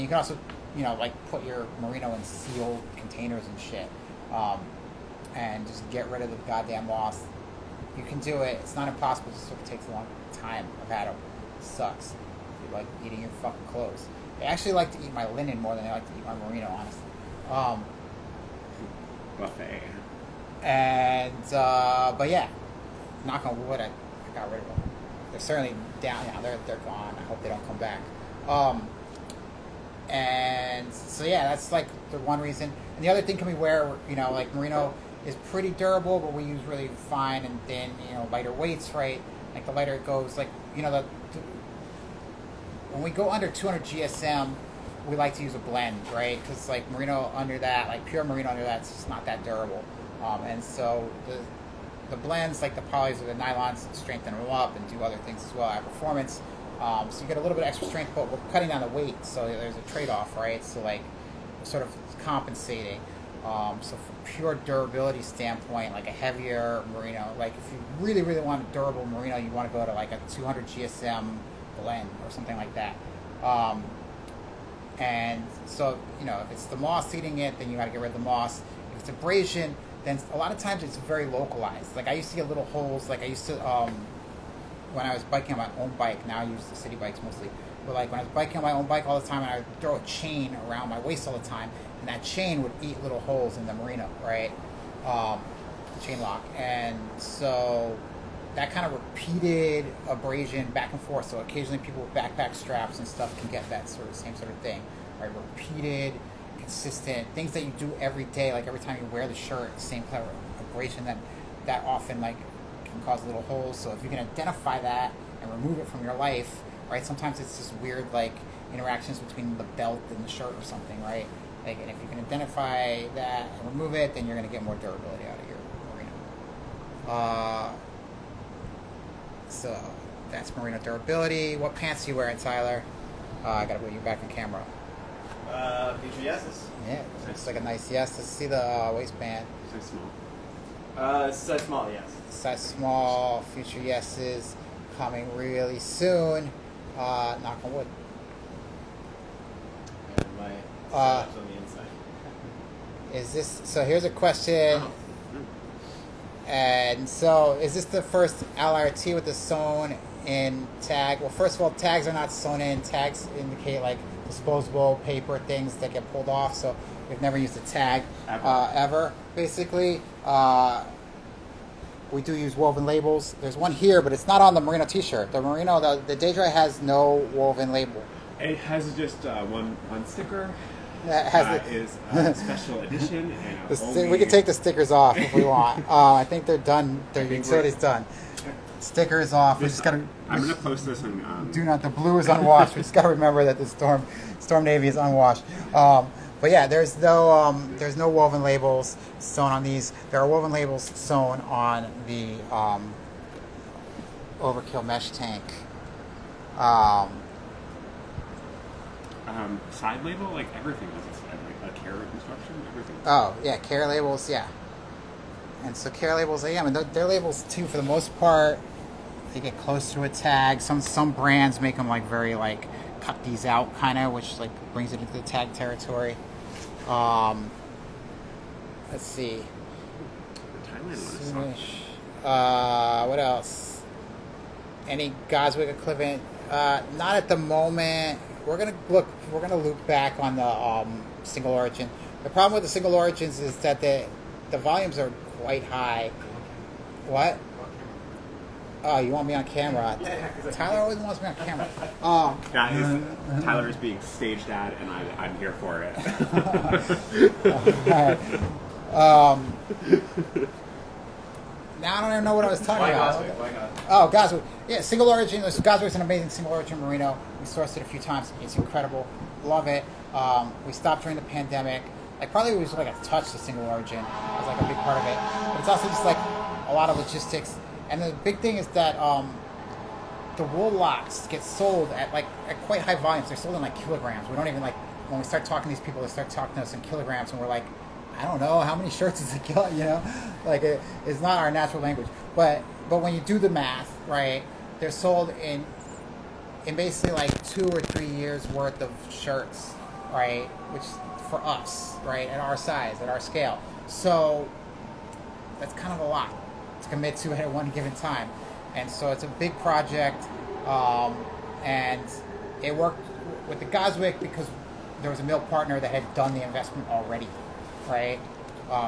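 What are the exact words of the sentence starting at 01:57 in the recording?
Sometimes it's just weird like interactions between the belt and the shirt or something, right?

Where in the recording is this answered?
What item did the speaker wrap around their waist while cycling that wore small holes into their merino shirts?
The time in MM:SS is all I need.
01:36.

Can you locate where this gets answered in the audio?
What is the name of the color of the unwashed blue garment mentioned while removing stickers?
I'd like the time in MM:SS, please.
03:14.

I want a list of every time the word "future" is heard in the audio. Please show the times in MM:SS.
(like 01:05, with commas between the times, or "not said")
02:15, 02:23.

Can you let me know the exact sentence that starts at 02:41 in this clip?
Well, first of all, tags are not sewn in.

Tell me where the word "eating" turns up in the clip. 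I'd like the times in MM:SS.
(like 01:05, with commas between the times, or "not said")
00:13, 01:17.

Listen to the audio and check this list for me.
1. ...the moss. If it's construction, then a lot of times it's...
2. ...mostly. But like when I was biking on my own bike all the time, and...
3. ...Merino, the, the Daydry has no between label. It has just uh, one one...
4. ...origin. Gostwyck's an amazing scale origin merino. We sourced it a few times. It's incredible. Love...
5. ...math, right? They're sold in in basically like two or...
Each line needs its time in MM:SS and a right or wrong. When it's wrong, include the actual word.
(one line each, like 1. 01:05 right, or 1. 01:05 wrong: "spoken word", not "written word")
1. 01:18 wrong: "abrasion", not "construction"
2. 01:27 right
3. 02:55 wrong: "woven", not "between"
4. 04:25 wrong: "single", not "scale"
5. 04:53 right.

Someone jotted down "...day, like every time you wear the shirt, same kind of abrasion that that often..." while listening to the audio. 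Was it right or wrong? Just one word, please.
right.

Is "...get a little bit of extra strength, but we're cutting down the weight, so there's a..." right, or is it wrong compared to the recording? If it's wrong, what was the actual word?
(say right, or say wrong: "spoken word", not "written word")
right.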